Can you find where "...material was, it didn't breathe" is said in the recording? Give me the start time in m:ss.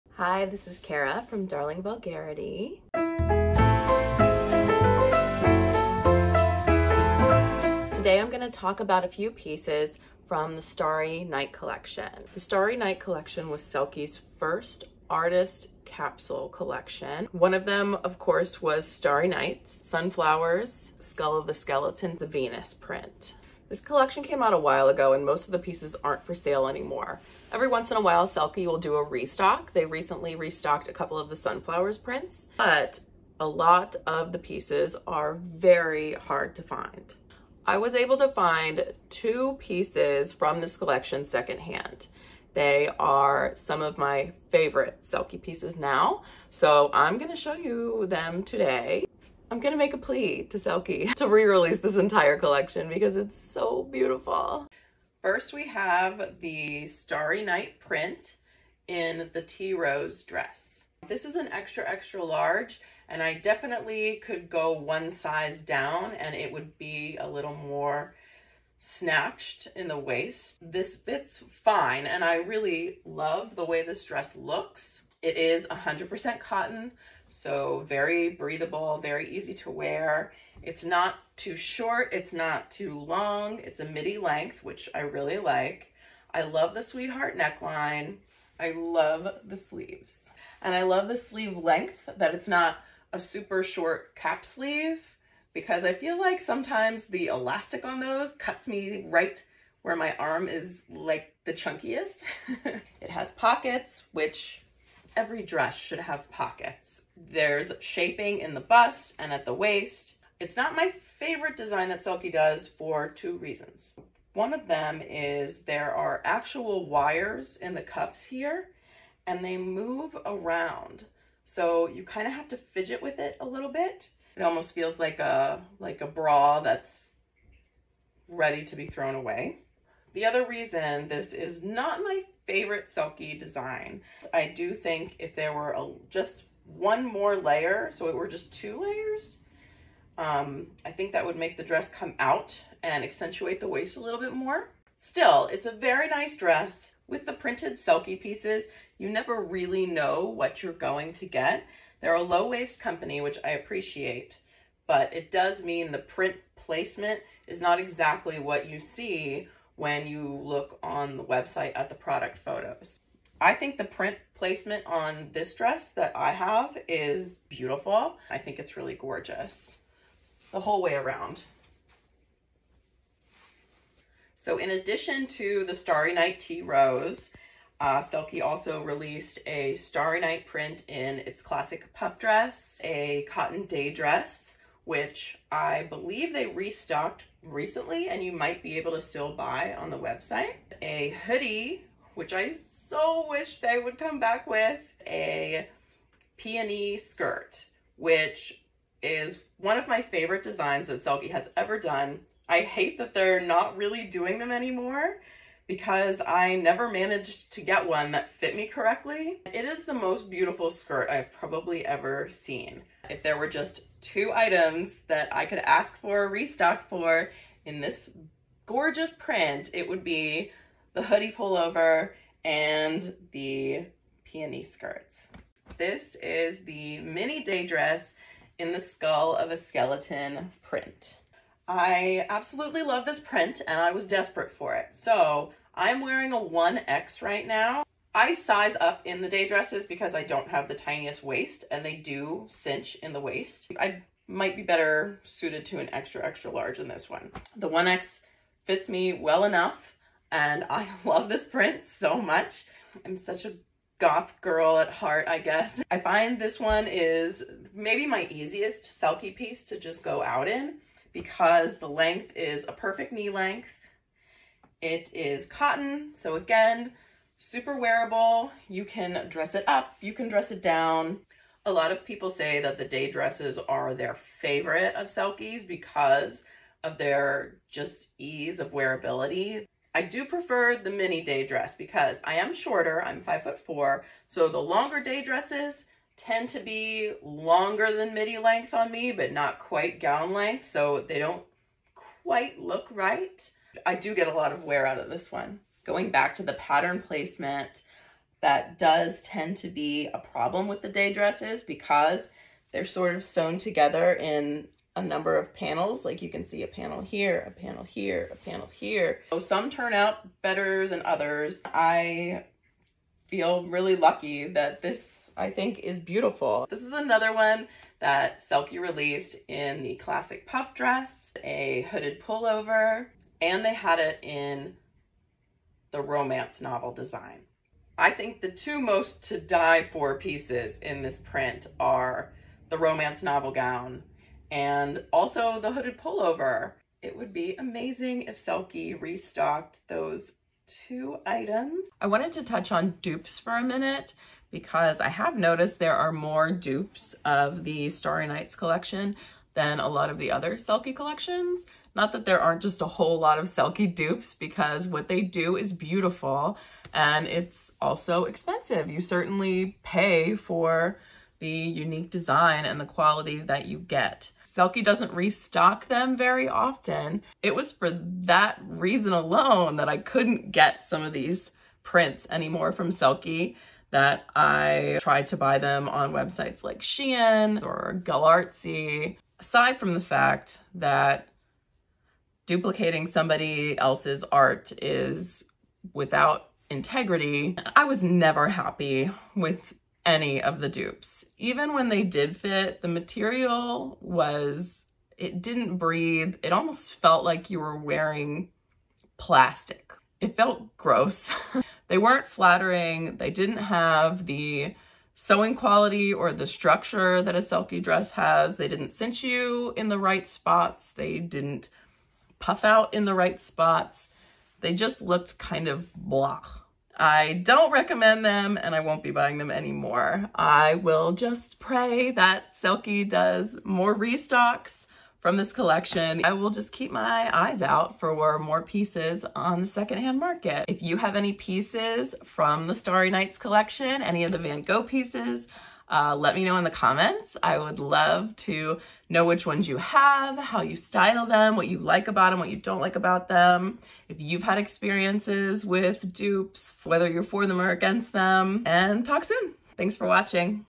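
6:32.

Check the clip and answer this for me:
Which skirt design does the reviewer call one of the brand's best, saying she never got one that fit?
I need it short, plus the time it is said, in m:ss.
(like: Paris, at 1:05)
peony skirt, at 3:16.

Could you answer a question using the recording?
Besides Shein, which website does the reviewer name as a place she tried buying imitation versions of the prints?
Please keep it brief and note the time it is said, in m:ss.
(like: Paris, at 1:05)
Galartsy, at 6:18.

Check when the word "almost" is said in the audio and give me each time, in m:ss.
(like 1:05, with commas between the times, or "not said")
2:04, 6:36.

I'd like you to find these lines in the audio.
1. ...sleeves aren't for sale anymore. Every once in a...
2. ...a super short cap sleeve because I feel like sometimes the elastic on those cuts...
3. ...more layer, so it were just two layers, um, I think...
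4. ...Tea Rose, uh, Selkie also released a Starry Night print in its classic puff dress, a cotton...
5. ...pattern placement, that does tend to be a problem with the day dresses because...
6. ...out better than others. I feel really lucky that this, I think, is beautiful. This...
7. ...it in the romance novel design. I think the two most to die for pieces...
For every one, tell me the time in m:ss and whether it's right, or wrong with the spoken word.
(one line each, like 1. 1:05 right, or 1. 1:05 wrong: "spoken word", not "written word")
1. 0:25 wrong: "pieces", not "sleeves"
2. 1:33 right
3. 2:17 right
4. 2:56 right
5. 4:56 right
6. 5:09 right
7. 5:23 right.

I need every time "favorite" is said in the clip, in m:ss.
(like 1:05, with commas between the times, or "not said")
0:44, 1:50, 2:12, 3:20, 4:34.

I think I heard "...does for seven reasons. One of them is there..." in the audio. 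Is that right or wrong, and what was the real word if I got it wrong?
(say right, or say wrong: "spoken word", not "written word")
wrong: "two", not "seven".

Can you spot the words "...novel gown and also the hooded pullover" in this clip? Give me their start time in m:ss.
5:33.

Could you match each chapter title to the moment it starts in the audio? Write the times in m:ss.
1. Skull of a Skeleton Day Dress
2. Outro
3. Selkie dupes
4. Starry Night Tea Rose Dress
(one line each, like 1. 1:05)
1. 3:45
2. 7:00
3. 5:41
4. 0:54.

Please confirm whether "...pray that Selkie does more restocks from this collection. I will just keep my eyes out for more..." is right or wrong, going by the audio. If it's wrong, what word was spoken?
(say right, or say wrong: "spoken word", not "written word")
right.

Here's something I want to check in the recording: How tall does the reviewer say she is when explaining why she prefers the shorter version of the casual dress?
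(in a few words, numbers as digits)
5 foot 4.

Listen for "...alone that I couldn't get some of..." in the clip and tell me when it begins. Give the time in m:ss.
6:09.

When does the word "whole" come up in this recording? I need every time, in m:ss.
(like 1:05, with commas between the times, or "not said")
2:50, 5:52.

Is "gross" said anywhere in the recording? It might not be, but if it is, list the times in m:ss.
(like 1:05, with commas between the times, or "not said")
6:40.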